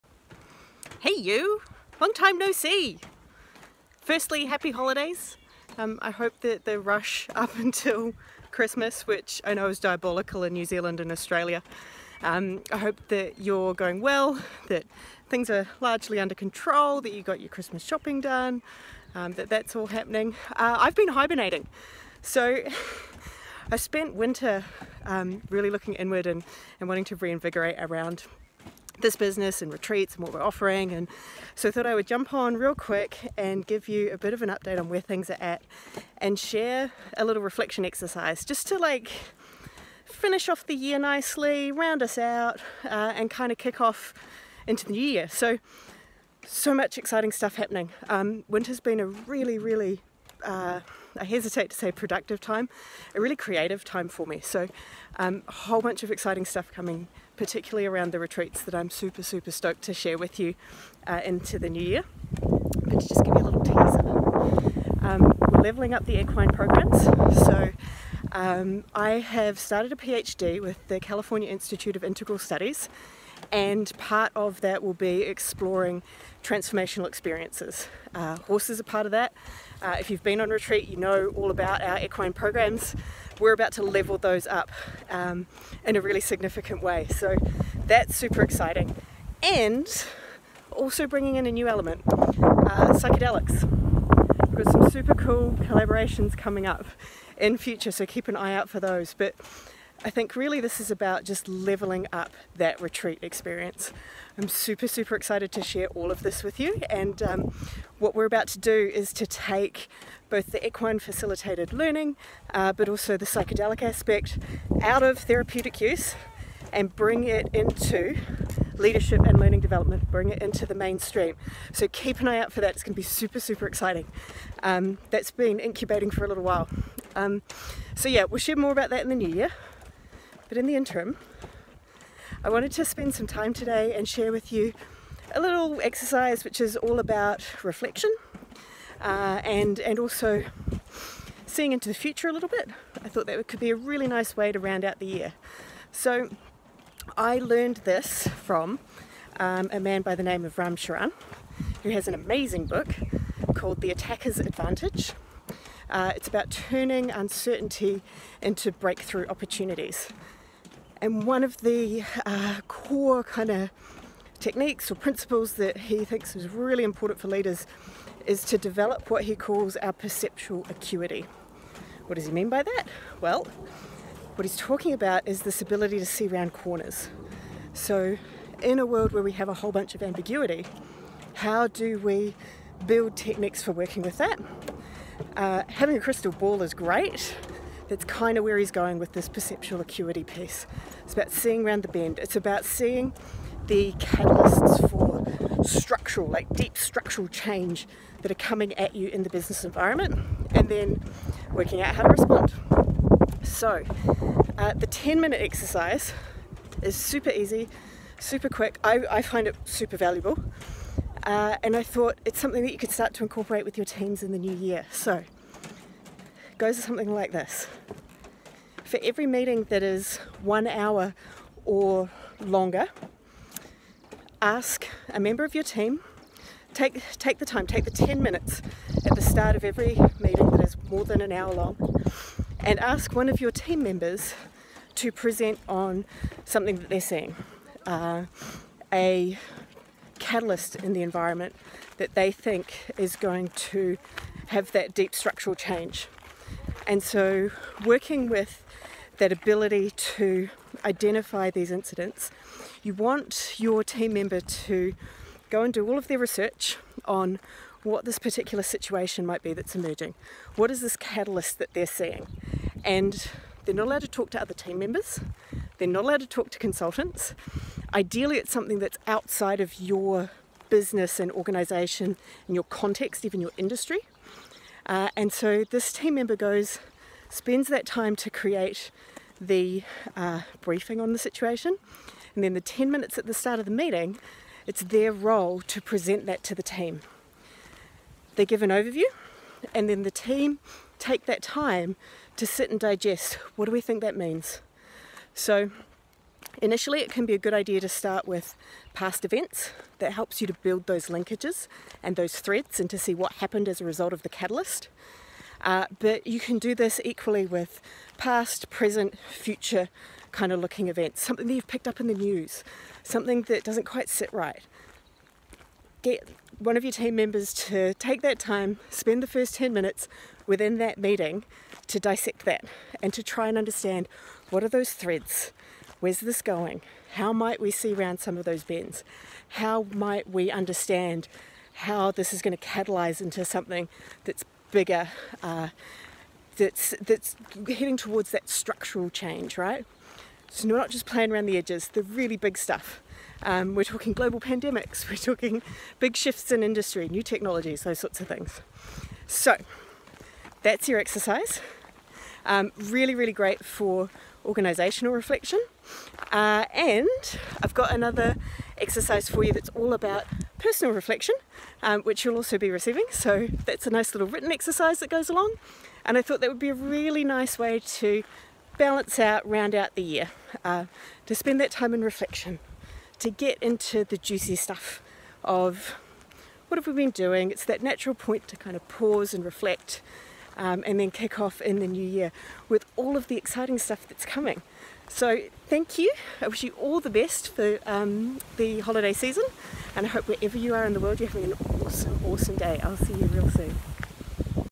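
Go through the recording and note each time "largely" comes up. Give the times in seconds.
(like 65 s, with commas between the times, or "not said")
15 s.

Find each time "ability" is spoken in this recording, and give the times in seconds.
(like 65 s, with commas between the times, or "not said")
175 s, 249 s.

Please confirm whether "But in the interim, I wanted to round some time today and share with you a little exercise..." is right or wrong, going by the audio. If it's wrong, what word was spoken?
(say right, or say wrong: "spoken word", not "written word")
wrong: "spend", not "round".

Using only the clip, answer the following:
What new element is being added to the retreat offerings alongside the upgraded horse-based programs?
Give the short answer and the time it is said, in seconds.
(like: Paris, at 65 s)
Psychedelics, at 92 s.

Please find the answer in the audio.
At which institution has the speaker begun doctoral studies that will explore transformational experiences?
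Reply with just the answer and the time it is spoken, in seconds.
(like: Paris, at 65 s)
California Institute of Integral Studies, at 71 s.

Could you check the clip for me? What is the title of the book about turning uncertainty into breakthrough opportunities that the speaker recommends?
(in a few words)
The Attacker's Advantage.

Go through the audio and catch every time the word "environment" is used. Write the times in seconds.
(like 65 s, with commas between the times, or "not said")
199 s, 241 s.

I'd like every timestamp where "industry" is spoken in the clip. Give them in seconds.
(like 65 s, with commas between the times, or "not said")
273 s, 346 s.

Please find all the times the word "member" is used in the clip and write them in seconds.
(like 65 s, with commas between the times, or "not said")
225 s, 233 s, 254 s, 264 s, 276 s, 317 s.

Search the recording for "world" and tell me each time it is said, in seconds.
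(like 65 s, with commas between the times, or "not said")
178 s, 391 s.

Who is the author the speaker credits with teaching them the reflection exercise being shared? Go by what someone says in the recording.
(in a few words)
Ram Charan.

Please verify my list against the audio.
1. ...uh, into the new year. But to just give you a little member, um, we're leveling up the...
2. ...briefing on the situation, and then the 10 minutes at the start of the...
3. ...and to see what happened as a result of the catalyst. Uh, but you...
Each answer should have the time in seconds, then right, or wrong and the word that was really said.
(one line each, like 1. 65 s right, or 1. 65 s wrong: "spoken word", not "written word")
1. 61 s wrong: "teaser", not "member"
2. 280 s right
3. 302 s right.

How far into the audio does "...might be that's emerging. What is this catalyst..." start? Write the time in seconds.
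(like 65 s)
259 s.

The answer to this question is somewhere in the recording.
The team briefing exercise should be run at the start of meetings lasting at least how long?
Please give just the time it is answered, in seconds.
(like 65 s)
220 s.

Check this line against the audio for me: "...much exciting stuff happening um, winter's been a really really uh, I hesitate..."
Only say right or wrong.
right.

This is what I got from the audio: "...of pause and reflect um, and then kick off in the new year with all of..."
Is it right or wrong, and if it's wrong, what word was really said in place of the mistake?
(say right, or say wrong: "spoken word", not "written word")
right.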